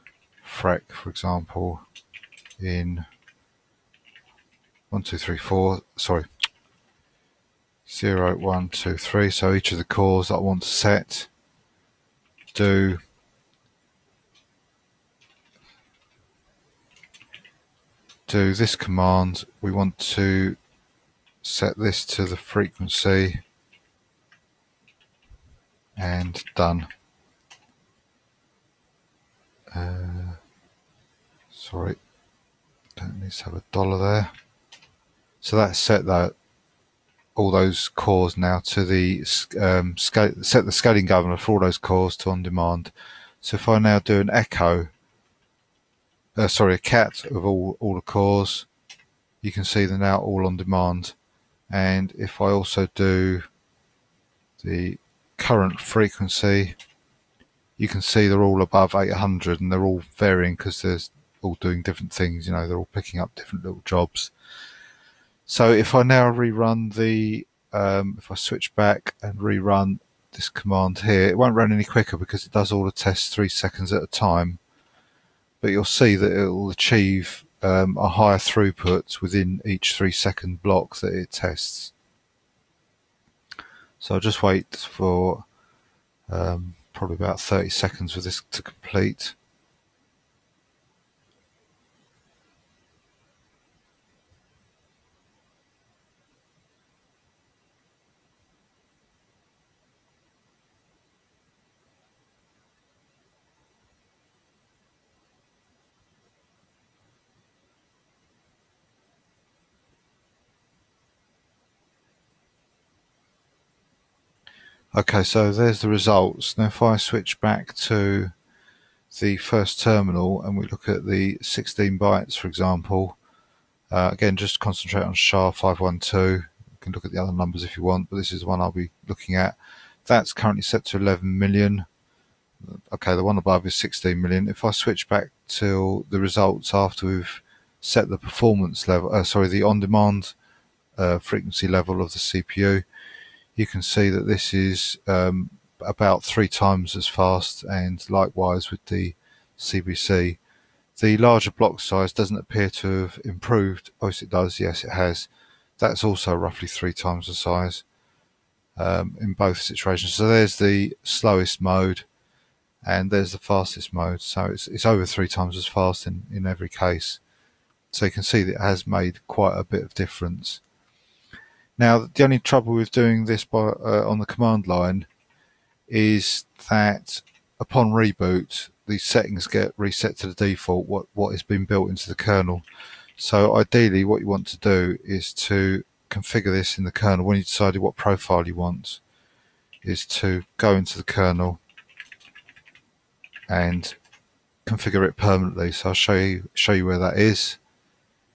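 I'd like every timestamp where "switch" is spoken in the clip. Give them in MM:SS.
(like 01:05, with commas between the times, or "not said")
01:08, 01:56, 02:14.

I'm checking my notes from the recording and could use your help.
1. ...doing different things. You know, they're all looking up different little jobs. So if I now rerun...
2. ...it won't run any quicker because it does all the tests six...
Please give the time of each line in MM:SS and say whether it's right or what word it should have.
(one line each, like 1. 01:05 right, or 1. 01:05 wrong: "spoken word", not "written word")
1. 01:01 wrong: "picking", not "looking"
2. 01:11 wrong: "three", not "six".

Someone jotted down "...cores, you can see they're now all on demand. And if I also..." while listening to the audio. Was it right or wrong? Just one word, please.
right.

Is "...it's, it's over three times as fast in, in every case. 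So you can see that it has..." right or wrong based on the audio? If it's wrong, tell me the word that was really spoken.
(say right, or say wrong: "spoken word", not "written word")
right.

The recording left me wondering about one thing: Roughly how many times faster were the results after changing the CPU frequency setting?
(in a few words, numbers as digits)
about 3 times.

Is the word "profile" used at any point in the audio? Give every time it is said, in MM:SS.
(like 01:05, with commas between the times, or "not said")
03:07.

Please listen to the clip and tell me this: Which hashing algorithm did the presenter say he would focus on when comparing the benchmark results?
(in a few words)
SHA-512.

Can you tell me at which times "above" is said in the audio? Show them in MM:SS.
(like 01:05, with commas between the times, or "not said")
00:58, 02:13.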